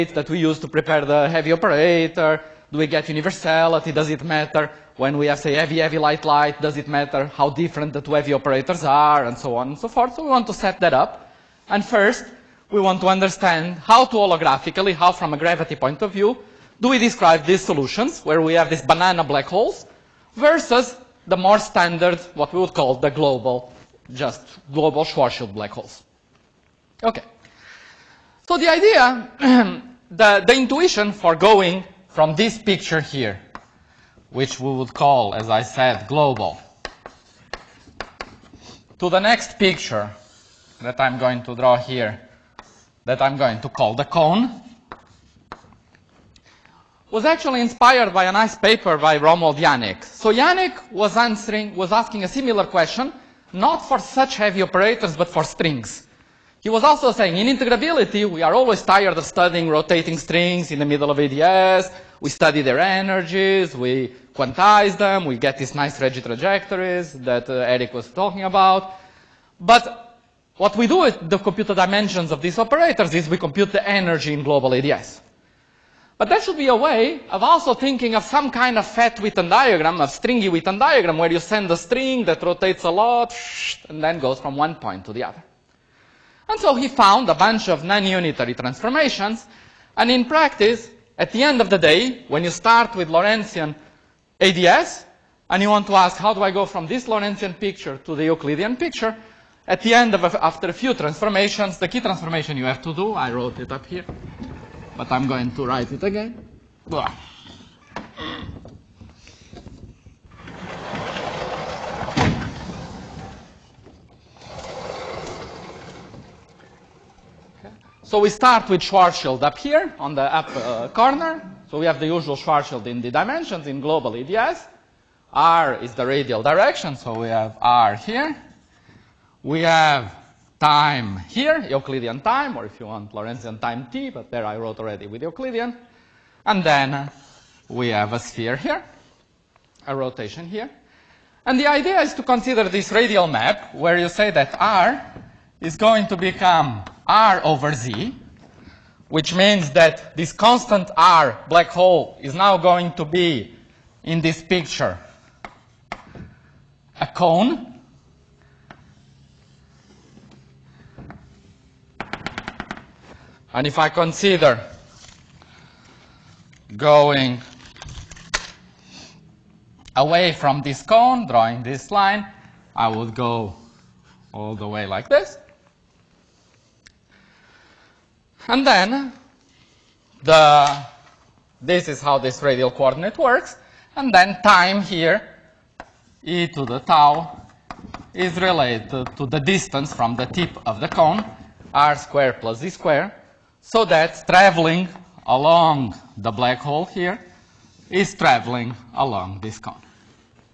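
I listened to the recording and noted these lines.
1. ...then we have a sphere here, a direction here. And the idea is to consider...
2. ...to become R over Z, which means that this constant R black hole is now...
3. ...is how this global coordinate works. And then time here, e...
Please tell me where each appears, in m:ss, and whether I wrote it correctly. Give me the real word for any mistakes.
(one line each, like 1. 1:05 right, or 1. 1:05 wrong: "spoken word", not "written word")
1. 2:16 wrong: "rotation", not "direction"
2. 2:26 right
3. 3:01 wrong: "radial", not "global".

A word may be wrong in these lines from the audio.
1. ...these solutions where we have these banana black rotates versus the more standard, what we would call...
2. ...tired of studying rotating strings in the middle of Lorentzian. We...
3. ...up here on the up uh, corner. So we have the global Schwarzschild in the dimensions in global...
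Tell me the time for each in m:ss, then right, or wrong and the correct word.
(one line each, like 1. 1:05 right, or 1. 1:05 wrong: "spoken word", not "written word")
1. 0:17 wrong: "holes", not "rotates"
2. 0:58 wrong: "ADS", not "Lorentzian"
3. 1:59 wrong: "usual", not "global".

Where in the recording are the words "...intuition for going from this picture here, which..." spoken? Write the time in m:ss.
0:30.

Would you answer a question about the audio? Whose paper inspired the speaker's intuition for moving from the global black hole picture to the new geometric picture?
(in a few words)
Romuald Janik.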